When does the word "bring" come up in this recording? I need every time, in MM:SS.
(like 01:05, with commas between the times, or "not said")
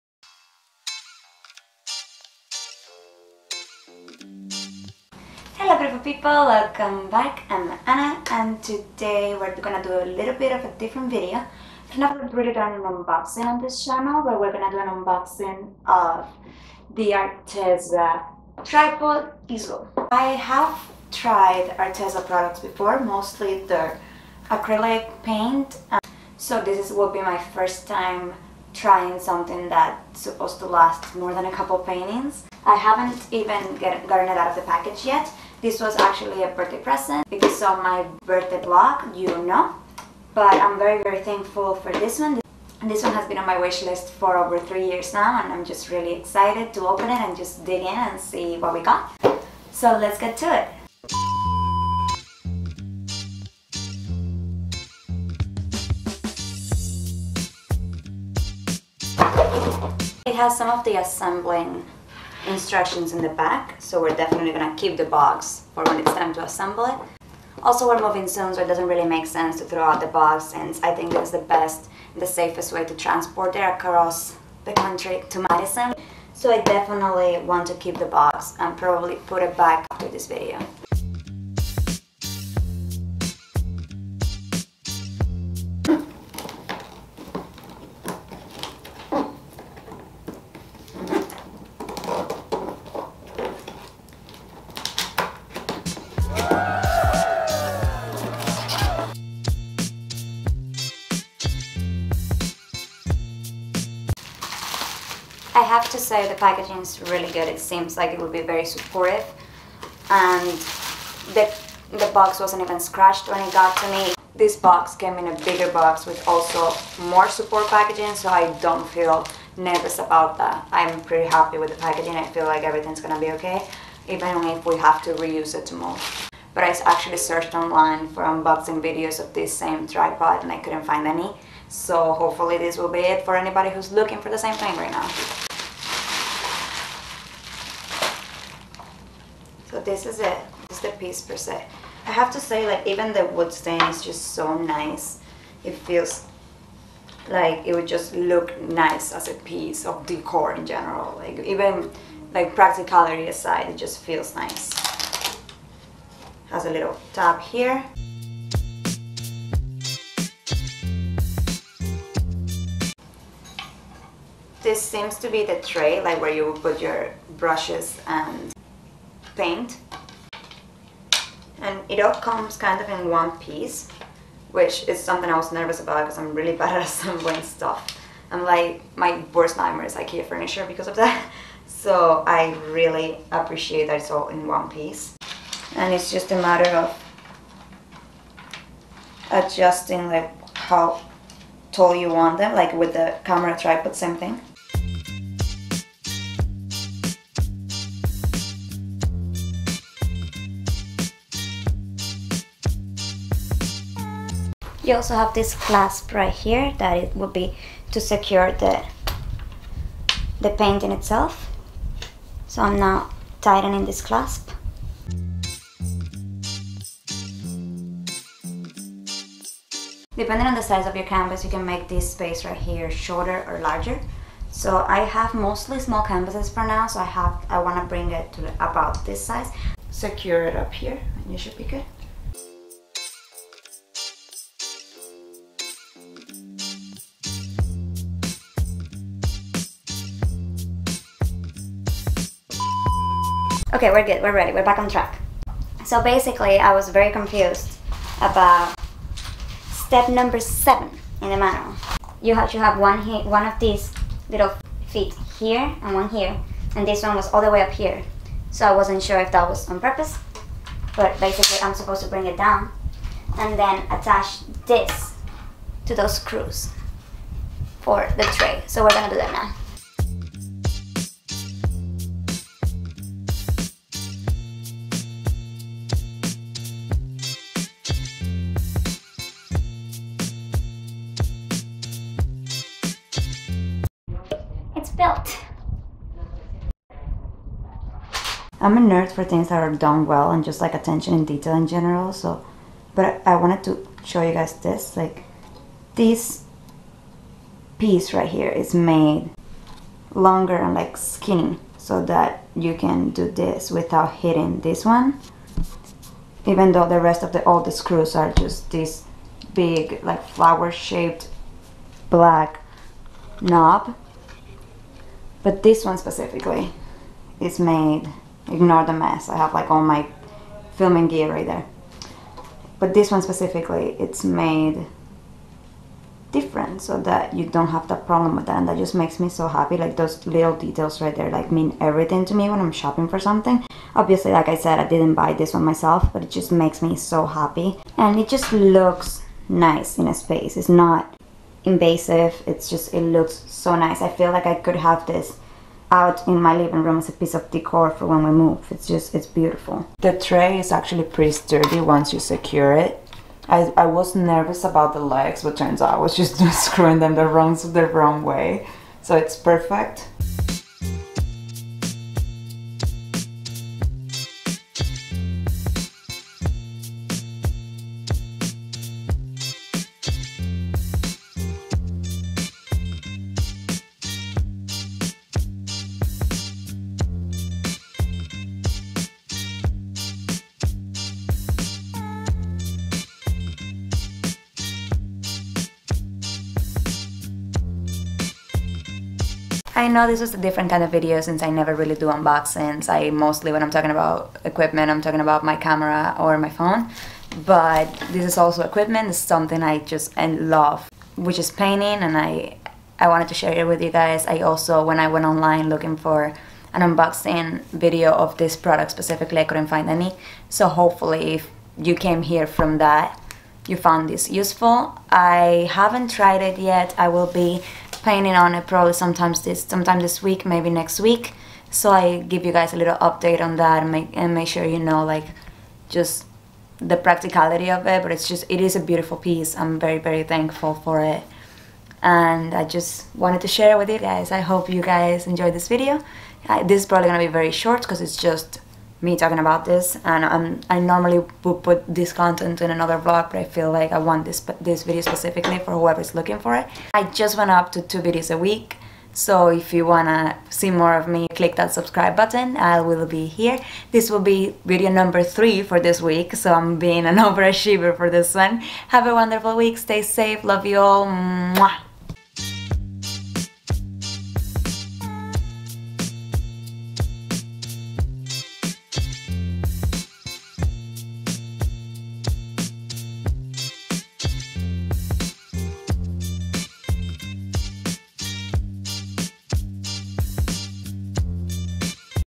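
03:47, 04:22.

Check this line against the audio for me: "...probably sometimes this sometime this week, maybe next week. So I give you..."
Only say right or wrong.
right.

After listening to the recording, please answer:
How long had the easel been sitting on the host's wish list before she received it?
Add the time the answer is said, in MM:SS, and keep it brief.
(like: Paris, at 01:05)
over three years, at 00:44.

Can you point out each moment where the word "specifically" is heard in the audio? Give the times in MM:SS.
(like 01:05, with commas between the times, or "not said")
05:15, 05:23, 06:48, 07:25.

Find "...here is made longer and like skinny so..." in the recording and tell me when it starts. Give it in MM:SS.
04:58.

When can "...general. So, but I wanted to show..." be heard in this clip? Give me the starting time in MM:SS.
04:51.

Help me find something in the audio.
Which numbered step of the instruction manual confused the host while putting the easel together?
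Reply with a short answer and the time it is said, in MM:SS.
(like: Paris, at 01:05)
7, at 04:10.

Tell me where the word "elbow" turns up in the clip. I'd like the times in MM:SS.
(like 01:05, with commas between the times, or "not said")
not said.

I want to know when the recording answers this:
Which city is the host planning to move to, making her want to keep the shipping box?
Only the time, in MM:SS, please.
01:15.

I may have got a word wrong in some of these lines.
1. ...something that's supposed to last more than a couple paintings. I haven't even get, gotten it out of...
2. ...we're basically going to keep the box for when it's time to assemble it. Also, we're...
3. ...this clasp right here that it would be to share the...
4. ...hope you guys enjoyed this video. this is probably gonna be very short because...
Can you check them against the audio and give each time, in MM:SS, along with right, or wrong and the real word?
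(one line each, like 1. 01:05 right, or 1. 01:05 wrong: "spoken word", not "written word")
1. 00:29 right
2. 01:04 wrong: "definitely", not "basically"
3. 03:25 wrong: "secure", not "share"
4. 07:14 right.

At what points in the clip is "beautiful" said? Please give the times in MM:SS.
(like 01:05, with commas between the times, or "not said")
00:05, 05:49, 07:08.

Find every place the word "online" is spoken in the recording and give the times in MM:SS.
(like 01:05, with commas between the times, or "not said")
02:07, 06:45.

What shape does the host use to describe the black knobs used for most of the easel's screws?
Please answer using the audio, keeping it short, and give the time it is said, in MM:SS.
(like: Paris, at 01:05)
flower shaped, at 05:10.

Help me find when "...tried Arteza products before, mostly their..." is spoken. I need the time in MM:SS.
00:21.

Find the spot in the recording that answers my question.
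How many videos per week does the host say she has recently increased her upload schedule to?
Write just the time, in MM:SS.
07:27.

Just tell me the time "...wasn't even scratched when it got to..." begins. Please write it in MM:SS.
01:52.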